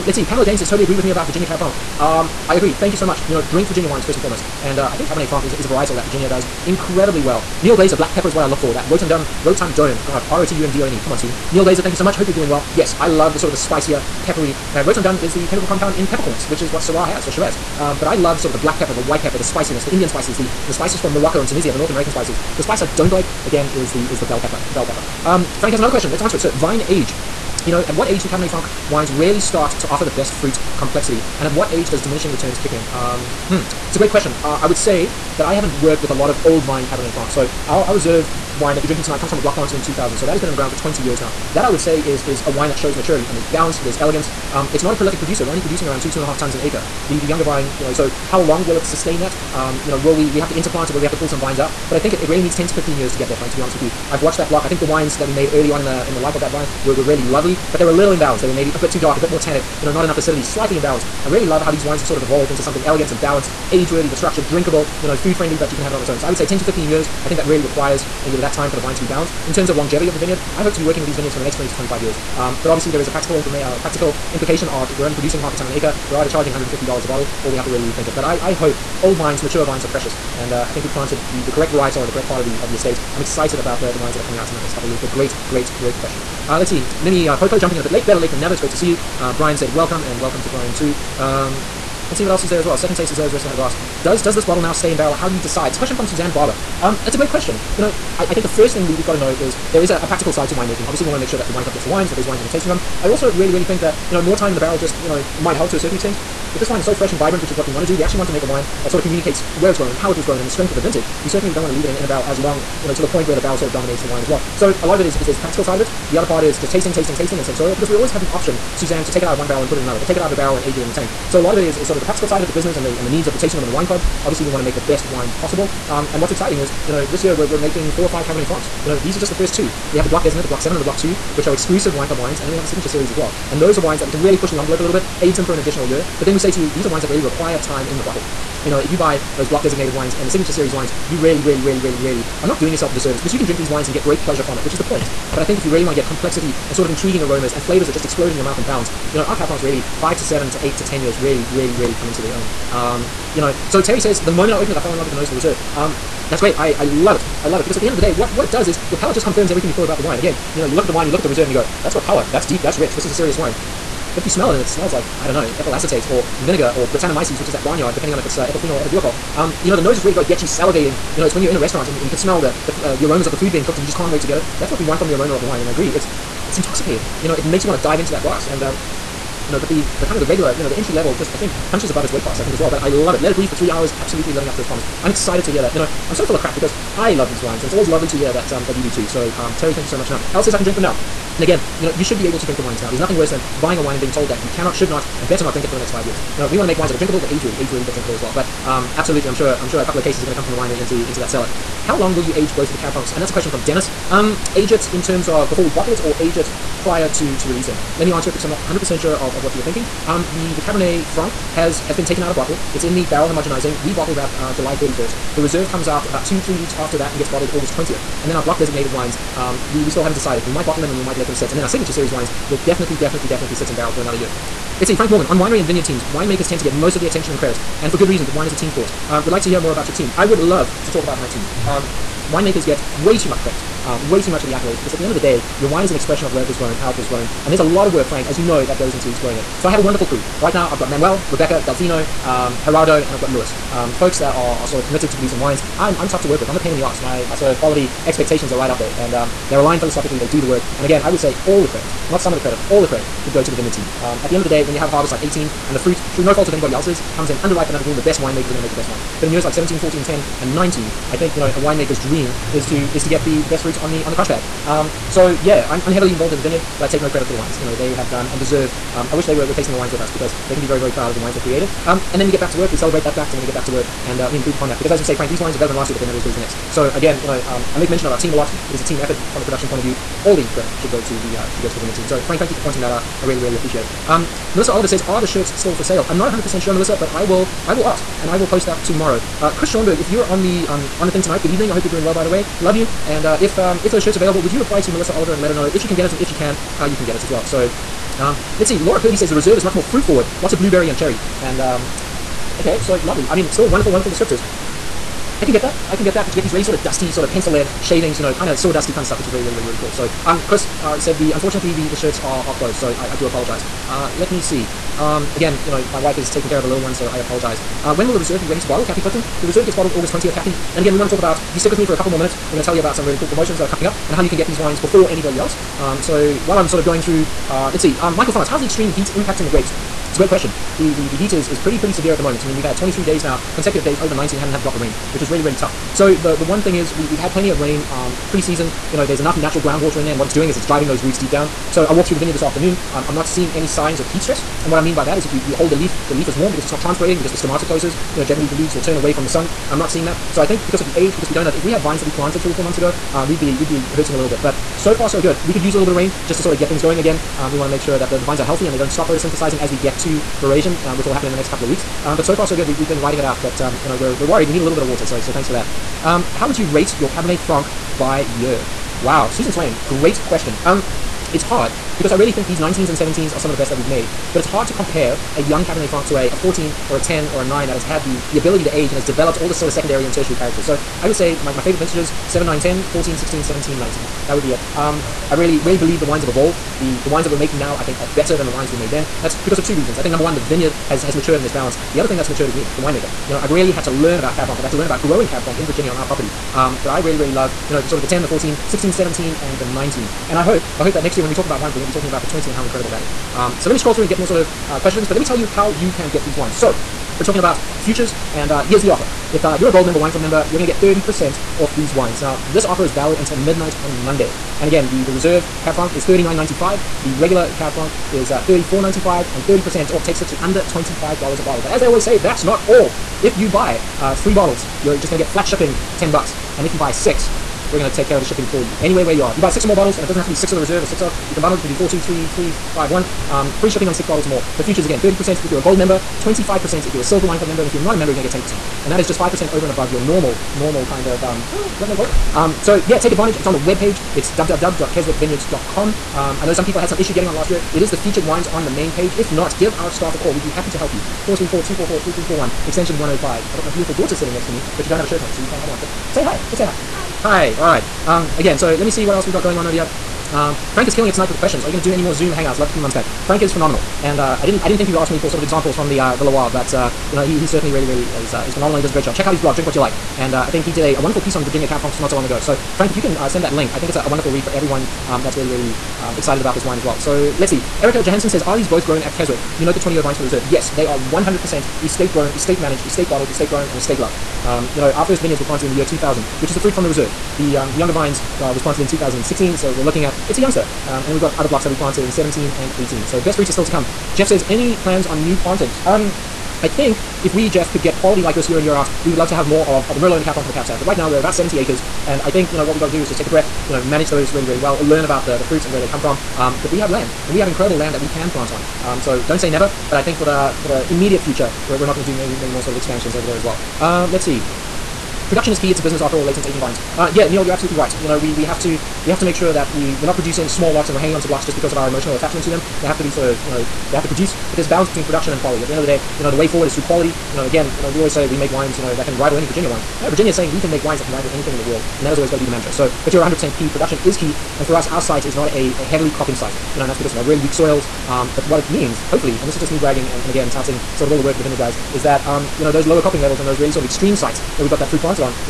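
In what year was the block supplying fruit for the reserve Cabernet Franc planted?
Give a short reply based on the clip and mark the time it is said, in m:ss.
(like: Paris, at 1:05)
2000, at 0:39.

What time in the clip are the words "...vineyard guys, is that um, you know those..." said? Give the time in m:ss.
9:01.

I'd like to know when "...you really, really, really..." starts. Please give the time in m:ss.
2:21.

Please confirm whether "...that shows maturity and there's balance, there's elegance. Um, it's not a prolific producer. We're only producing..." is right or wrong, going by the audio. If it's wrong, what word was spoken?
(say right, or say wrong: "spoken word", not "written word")
right.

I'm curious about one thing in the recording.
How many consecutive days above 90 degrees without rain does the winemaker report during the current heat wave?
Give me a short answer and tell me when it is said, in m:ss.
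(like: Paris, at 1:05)
23, at 5:32.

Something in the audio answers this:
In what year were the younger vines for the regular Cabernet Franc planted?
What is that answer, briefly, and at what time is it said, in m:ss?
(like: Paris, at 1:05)
2016, at 8:08.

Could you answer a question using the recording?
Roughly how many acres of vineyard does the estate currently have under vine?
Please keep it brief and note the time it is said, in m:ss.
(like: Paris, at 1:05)
70 acres, at 8:21.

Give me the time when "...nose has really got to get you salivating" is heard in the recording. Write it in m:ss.
2:49.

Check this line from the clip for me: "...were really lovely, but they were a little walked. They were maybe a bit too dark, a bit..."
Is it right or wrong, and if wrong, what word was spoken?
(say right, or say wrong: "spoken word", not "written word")
wrong: "imbalanced", not "walked".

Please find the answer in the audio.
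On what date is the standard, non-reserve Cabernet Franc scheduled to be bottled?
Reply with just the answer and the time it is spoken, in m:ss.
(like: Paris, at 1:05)
July 31st, at 3:34.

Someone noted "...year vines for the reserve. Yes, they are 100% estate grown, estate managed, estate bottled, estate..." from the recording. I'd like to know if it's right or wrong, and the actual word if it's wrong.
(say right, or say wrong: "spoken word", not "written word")
right.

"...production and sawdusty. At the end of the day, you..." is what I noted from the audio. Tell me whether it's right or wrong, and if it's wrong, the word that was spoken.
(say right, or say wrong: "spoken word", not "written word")
wrong: "quality", not "sawdusty".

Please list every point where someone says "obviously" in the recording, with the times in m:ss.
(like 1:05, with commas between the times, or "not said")
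1:12, 1:40, 2:04.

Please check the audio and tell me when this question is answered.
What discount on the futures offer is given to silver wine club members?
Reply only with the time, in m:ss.
7:16.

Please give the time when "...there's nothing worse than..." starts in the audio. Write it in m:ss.
3:12.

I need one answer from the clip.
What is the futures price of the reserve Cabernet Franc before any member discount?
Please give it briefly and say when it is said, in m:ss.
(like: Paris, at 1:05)
$39.95, at 6:56.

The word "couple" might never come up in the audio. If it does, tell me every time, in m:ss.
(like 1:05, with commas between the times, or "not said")
1:24, 3:19, 5:21, 6:01.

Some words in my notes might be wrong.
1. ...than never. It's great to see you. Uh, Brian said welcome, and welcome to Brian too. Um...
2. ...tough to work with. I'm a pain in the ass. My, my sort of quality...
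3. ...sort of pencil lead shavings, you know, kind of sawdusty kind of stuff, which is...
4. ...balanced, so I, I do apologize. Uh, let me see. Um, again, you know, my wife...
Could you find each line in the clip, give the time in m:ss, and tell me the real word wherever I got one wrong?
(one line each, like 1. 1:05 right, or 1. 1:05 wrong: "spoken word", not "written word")
1. 1:28 right
2. 4:06 right
3. 5:07 right
4. 5:12 wrong: "closed", not "balanced".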